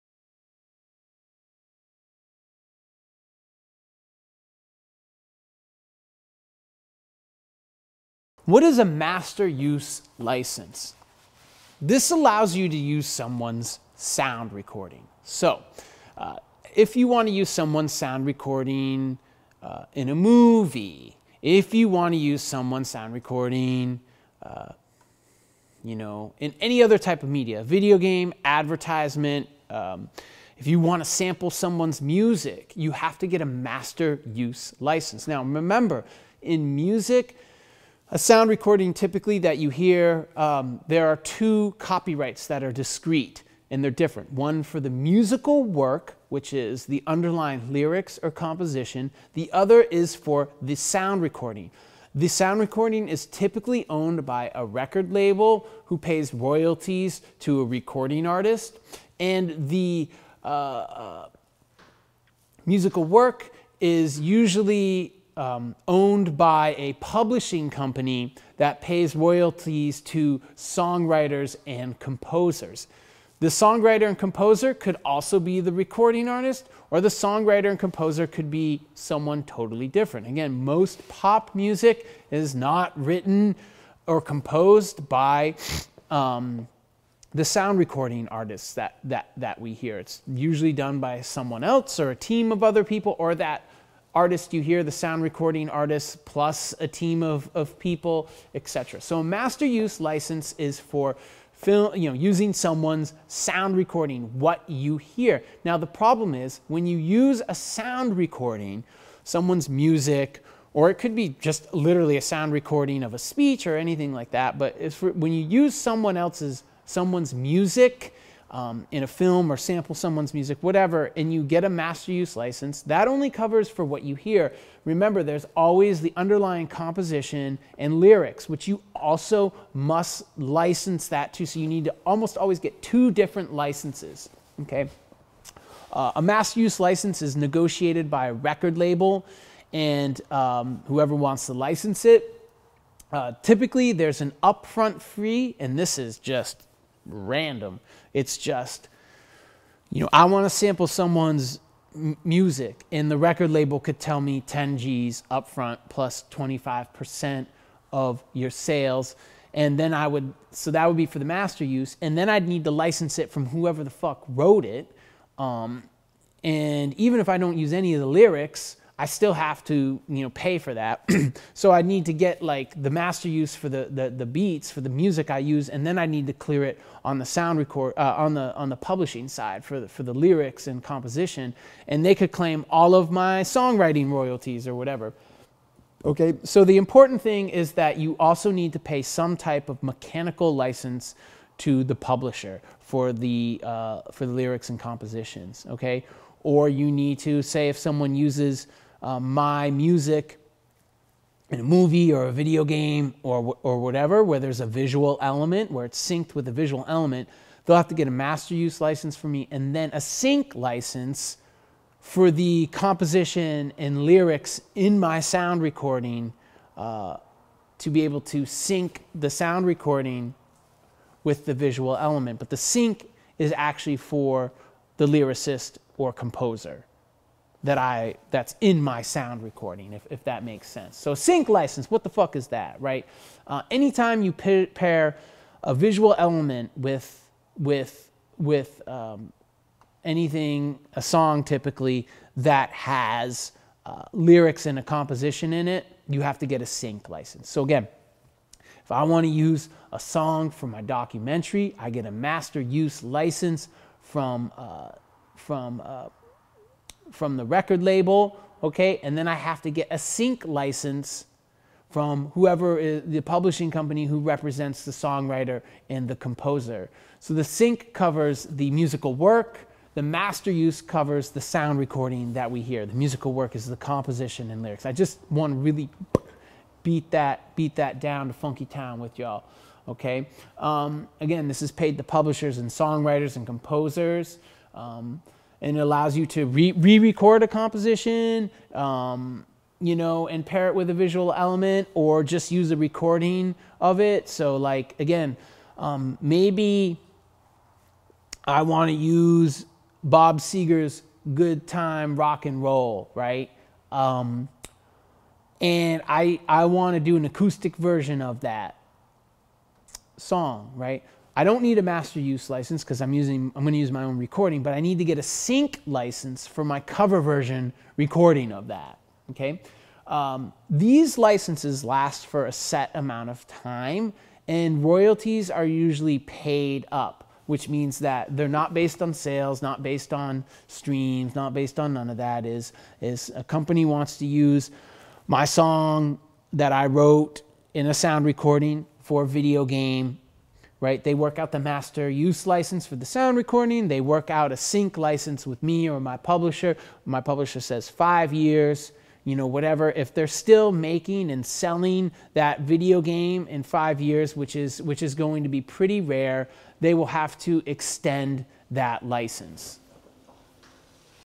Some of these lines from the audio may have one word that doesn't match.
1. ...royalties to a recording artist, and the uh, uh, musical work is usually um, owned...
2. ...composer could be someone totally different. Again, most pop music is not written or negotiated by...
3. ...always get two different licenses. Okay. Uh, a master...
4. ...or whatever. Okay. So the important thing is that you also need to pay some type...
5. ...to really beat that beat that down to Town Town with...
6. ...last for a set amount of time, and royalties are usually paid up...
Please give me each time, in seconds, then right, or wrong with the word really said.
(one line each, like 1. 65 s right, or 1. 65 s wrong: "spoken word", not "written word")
1. 56 s right
2. 77 s wrong: "composed", not "negotiated"
3. 132 s right
4. 184 s right
5. 275 s wrong: "Funky", not "Town"
6. 321 s right.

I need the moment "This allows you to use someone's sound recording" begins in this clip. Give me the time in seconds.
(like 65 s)
11 s.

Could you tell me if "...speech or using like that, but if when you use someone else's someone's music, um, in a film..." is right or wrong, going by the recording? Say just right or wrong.
wrong.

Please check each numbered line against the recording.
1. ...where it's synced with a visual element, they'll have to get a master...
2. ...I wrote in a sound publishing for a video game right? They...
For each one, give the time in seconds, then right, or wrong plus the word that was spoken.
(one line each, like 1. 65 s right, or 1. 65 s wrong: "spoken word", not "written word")
1. 205 s right
2. 336 s wrong: "recording", not "publishing".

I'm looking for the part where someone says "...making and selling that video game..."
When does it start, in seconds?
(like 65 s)
350 s.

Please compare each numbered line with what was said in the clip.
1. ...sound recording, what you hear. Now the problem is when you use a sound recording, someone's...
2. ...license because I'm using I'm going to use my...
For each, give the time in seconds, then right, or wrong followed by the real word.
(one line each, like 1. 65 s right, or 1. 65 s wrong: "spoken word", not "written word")
1. 103 s right
2. 312 s right.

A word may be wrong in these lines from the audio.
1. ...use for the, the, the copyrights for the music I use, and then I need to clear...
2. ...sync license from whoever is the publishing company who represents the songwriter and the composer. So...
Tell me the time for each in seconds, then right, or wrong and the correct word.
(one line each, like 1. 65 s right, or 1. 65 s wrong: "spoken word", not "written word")
1. 173 s wrong: "beats", not "copyrights"
2. 259 s right.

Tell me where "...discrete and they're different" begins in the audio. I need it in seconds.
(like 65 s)
42 s.